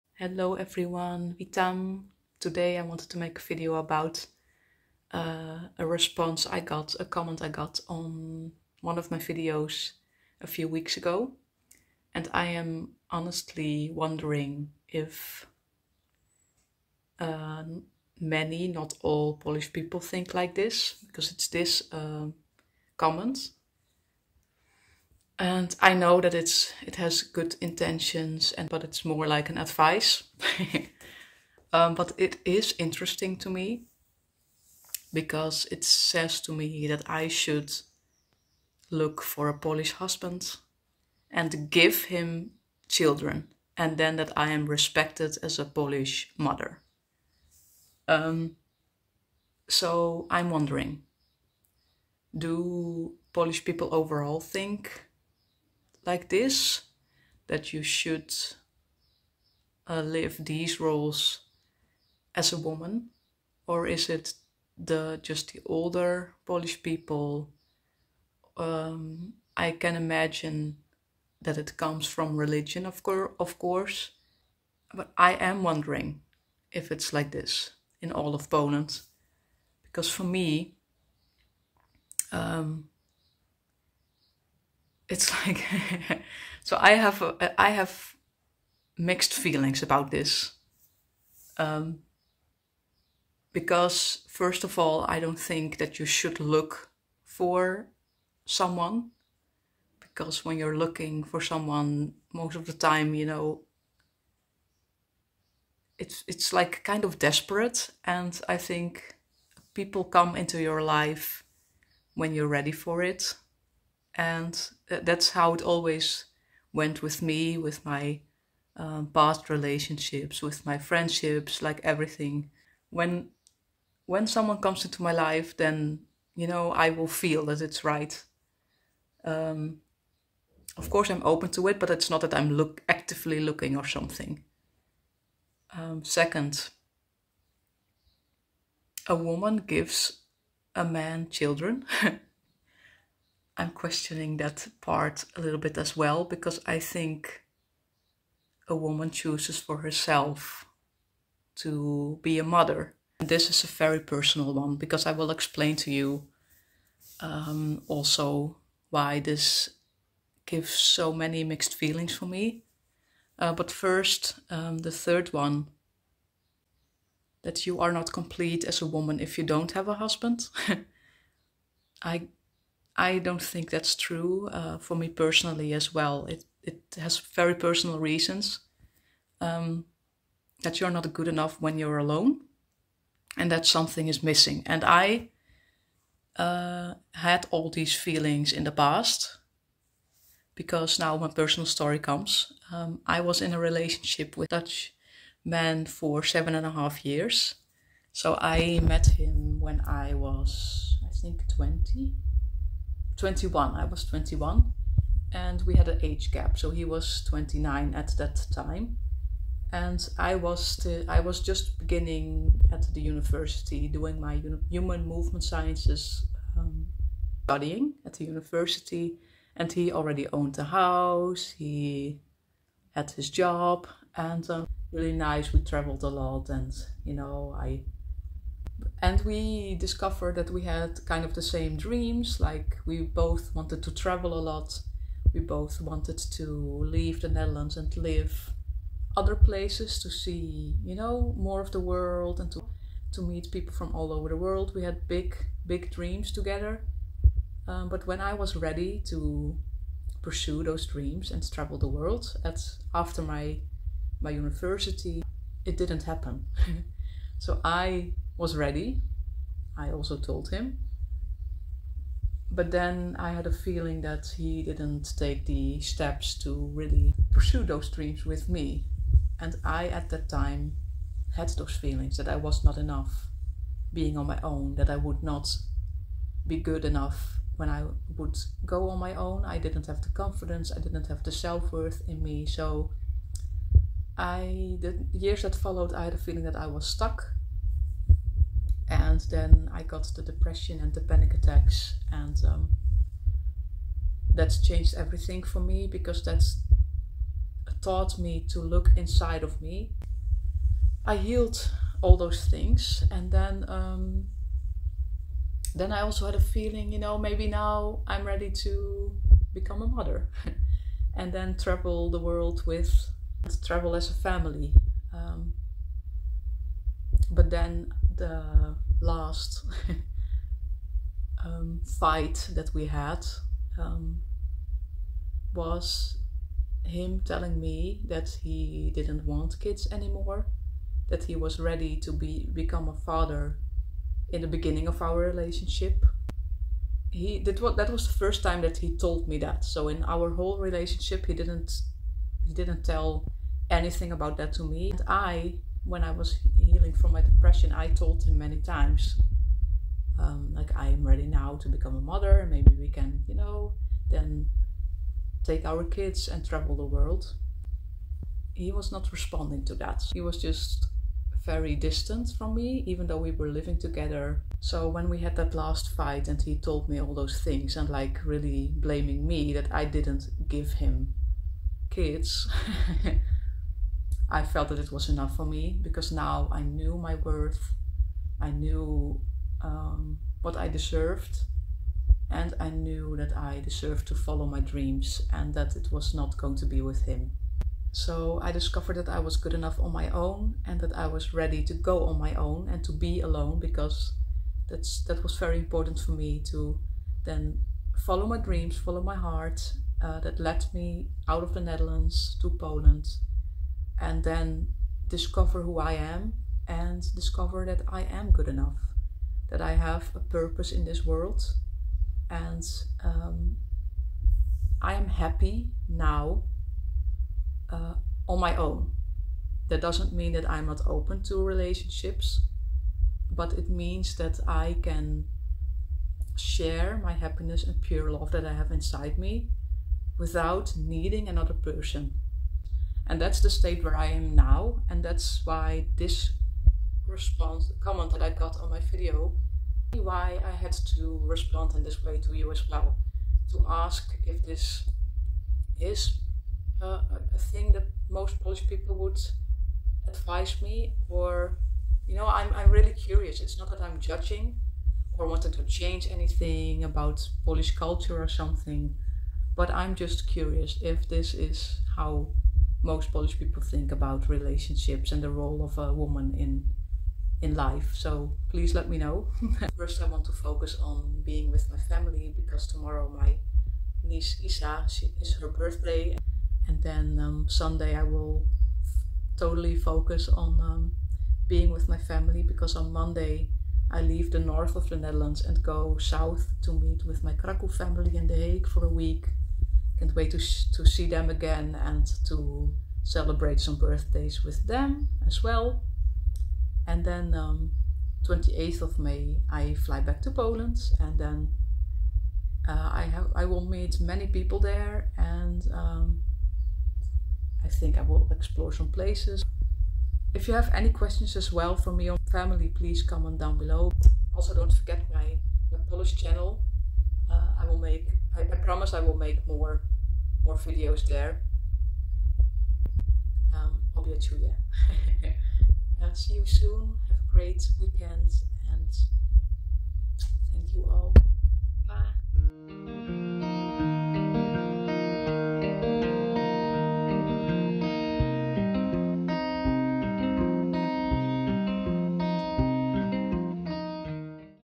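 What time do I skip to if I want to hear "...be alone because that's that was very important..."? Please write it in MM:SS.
06:32.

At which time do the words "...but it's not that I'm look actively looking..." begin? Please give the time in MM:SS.
02:11.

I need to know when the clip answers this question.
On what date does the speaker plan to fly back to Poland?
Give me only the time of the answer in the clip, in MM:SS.
08:18.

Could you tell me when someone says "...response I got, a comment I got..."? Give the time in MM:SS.
00:05.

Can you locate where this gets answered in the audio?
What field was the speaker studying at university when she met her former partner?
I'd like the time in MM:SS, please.
03:34.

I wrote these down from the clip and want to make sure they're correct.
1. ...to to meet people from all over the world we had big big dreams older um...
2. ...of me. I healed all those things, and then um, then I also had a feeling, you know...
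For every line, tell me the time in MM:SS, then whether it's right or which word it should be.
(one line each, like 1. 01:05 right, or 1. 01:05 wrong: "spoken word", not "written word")
1. 04:02 wrong: "together", not "older"
2. 04:59 right.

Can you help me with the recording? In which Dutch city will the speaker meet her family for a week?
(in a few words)
The Hague.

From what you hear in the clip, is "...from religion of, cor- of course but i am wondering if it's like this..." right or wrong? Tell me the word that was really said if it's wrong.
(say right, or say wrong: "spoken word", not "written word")
right.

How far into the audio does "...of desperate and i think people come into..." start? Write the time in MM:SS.
01:47.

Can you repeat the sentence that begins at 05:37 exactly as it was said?
He did what that was the first time that he told me that.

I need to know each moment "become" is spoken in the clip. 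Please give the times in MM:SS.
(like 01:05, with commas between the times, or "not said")
05:09, 05:32, 05:51.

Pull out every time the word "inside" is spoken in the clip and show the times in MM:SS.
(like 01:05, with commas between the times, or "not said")
04:58, 07:08.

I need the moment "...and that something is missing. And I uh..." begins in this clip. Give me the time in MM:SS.
03:03.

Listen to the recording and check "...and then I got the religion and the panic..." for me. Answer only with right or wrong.
wrong.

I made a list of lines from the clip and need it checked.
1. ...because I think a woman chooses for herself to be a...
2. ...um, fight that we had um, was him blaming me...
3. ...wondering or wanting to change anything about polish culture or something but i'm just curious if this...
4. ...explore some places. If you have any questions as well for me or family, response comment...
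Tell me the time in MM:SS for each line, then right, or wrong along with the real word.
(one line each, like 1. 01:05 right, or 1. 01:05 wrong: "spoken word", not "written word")
1. 02:26 right
2. 05:21 wrong: "telling", not "blaming"
3. 07:33 wrong: "judging", not "wondering"
4. 08:28 wrong: "please", not "response".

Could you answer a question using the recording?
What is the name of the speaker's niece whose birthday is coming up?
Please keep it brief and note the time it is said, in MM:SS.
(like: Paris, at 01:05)
Isa, at 07:54.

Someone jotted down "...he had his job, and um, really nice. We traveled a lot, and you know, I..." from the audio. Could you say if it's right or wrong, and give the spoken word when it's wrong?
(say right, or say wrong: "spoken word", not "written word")
right.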